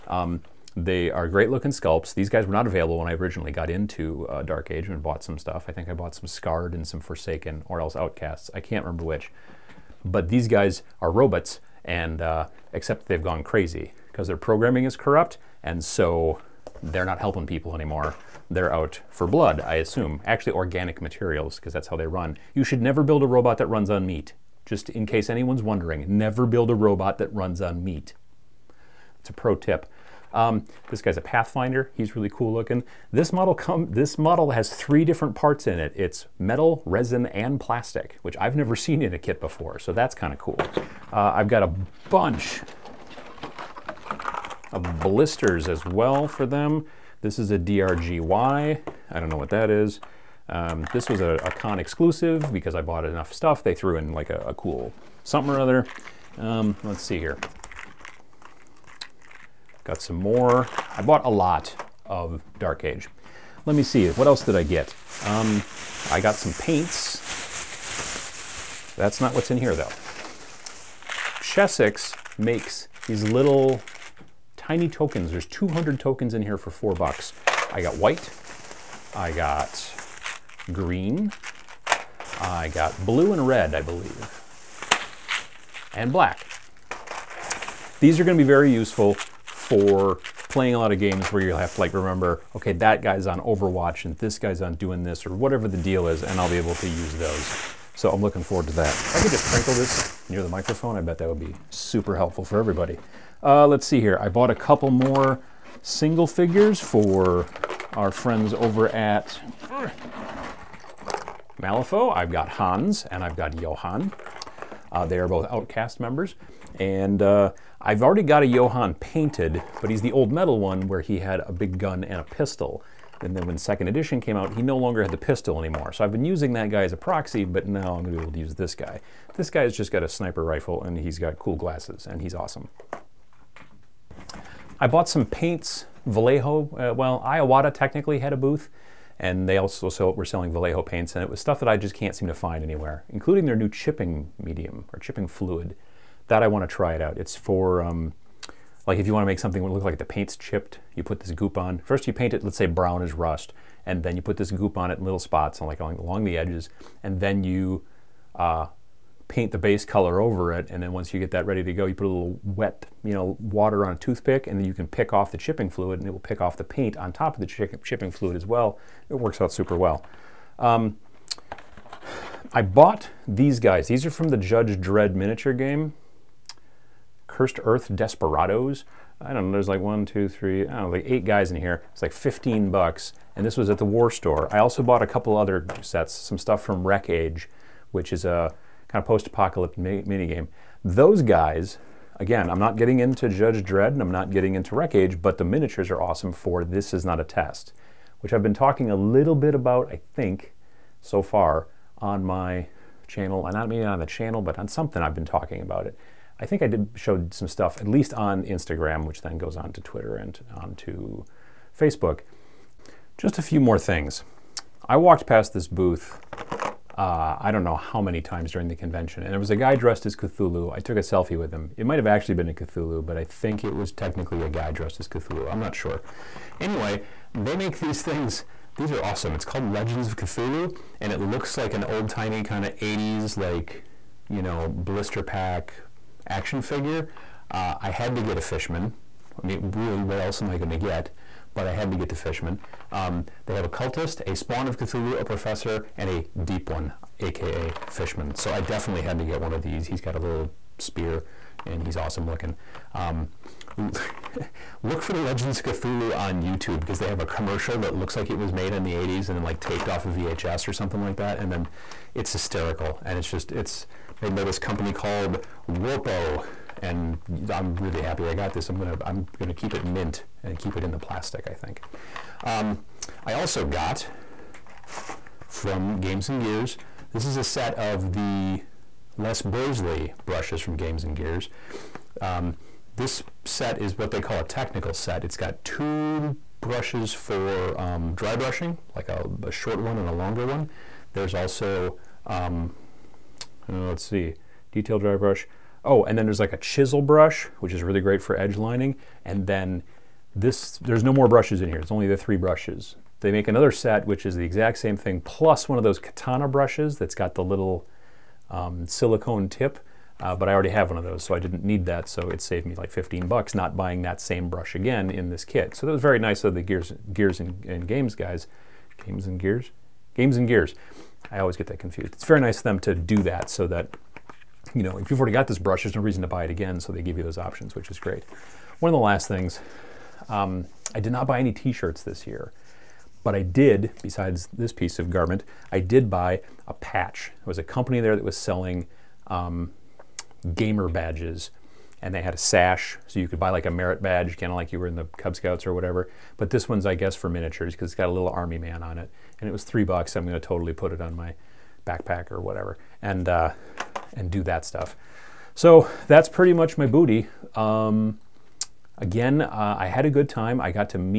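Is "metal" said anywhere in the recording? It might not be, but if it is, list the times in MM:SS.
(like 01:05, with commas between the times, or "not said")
00:36, 02:00.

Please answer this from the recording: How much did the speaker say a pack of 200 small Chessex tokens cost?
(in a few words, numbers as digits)
4 dollars.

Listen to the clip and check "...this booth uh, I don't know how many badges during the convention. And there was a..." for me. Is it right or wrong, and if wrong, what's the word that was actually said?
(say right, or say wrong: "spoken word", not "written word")
wrong: "times", not "badges".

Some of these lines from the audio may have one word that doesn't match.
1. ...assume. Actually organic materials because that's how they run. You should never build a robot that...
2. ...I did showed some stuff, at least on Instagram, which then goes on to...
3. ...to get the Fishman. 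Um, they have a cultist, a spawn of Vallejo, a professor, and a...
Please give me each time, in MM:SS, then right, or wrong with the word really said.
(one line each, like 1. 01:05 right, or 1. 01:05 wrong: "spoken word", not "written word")
1. 00:19 right
2. 03:26 right
3. 04:01 wrong: "Cthulhu", not "Vallejo".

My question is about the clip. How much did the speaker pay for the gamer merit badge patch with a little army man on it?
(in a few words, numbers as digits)
3 dollars.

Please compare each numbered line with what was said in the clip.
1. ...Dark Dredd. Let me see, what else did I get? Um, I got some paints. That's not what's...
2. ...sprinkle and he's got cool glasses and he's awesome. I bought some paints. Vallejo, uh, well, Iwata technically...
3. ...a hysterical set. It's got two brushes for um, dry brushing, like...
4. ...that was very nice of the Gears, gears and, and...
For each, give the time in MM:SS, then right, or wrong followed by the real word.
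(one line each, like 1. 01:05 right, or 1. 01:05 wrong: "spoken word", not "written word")
1. 01:02 wrong: "Age", not "Dredd"
2. 02:10 wrong: "rifle", not "sprinkle"
3. 04:44 wrong: "technical", not "hysterical"
4. 05:15 right.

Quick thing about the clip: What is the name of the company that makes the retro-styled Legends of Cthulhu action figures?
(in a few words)
Warpo.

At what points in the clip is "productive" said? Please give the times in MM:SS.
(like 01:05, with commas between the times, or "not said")
not said.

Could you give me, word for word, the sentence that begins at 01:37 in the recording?
So I'm looking forward to that.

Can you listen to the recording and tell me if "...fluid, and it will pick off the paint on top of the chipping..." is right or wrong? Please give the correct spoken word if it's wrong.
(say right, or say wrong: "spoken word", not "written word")
right.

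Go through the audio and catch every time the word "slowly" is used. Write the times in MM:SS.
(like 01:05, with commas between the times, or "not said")
not said.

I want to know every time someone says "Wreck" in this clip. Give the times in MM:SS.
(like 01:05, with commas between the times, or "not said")
03:06, 03:14.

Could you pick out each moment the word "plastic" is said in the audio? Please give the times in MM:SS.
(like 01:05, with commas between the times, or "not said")
00:37, 04:30.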